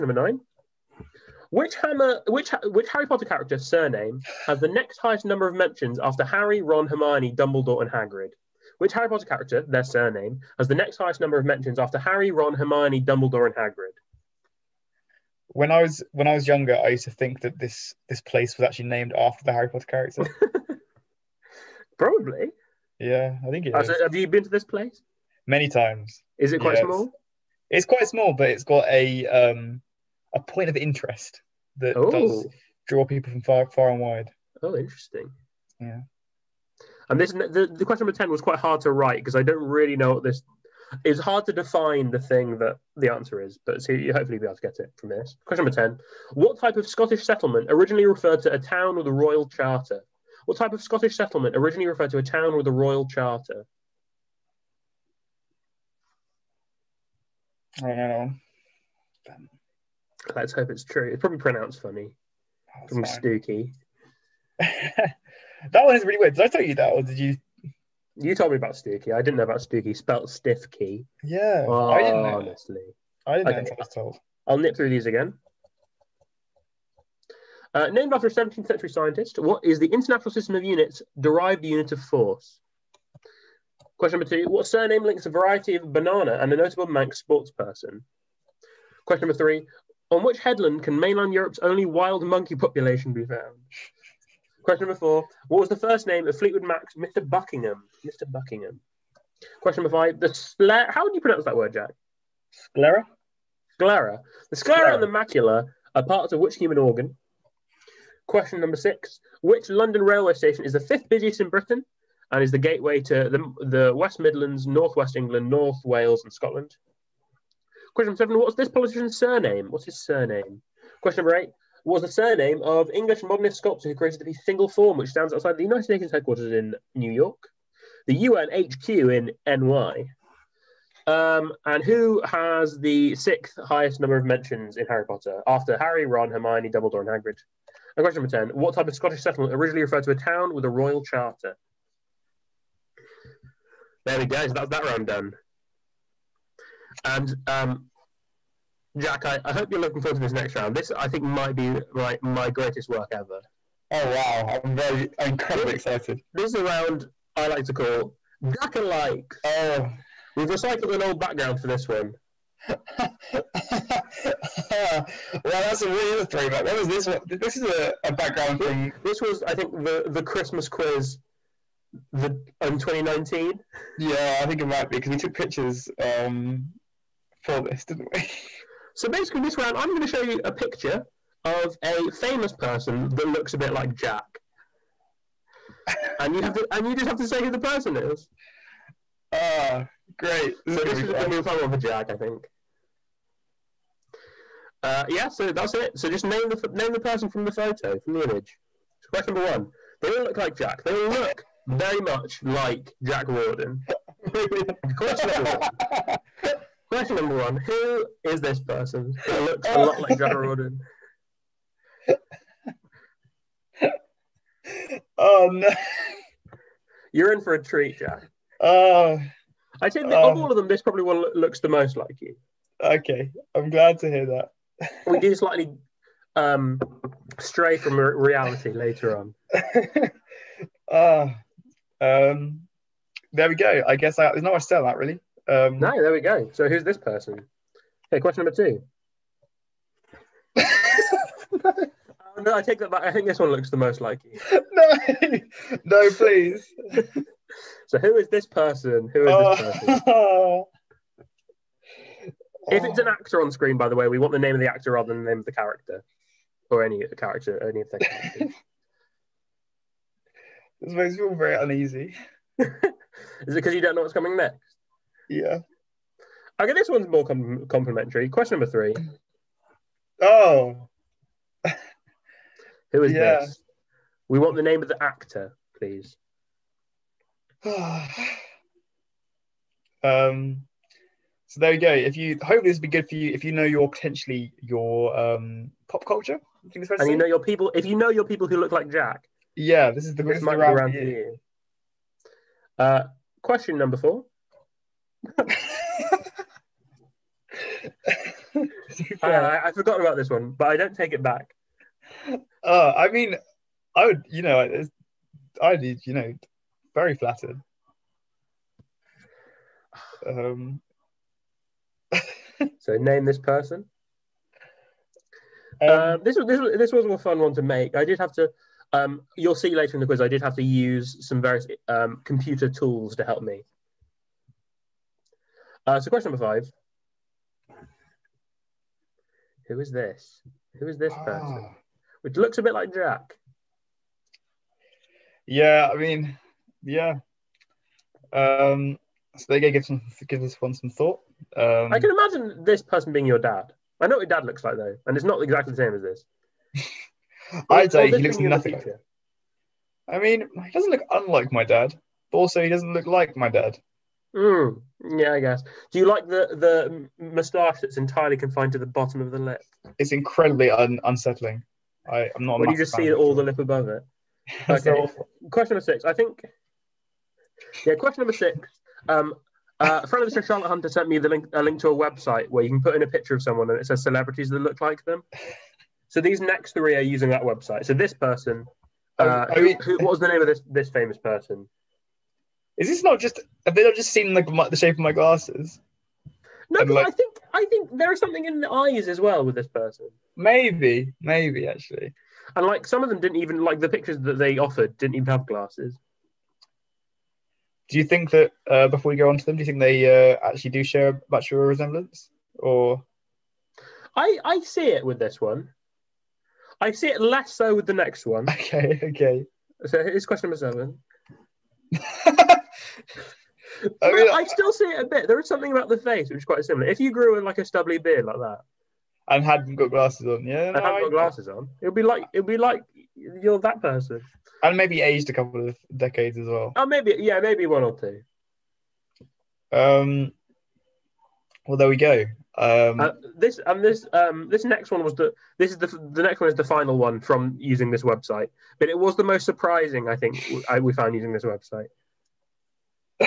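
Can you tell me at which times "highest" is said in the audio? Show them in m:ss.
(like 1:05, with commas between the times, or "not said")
0:04, 0:10, 2:13.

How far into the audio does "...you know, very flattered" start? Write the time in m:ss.
5:06.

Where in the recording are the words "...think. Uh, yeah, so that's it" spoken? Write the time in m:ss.
3:12.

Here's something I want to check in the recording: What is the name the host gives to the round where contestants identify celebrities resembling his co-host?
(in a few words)
Jack Alike.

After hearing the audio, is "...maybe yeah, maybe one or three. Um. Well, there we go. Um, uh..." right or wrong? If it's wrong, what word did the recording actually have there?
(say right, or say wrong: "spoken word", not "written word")
wrong: "two", not "three".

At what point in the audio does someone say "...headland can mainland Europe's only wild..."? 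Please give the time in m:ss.
1:30.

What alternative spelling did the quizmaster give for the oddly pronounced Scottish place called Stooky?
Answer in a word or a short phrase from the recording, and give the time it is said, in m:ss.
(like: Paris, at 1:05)
Stiff key, at 1:09.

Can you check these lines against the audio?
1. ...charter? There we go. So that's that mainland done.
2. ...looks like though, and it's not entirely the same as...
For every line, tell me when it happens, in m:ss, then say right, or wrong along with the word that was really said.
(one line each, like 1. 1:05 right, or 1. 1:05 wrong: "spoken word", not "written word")
1. 2:21 wrong: "round", not "mainland"
2. 5:44 wrong: "exactly", not "entirely".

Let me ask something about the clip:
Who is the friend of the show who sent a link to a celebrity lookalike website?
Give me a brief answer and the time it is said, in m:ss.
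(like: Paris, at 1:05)
Charlotte Hunter, at 6:10.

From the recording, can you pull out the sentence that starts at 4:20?
this makes me feel very uneasy.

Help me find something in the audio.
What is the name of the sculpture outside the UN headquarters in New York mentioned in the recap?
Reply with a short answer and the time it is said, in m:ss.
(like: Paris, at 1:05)
Single Form, at 2:04.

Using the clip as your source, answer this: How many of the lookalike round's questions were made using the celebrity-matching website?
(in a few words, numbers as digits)
3.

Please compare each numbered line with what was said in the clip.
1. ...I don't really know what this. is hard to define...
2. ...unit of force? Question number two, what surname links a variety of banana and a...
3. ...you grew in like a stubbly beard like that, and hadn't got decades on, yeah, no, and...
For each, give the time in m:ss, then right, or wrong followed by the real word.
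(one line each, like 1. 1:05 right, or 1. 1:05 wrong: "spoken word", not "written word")
1. 0:39 right
2. 1:21 right
3. 6:56 wrong: "glasses", not "decades".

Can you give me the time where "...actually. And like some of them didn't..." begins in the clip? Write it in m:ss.
6:31.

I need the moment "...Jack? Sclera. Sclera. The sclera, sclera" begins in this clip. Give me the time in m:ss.
1:41.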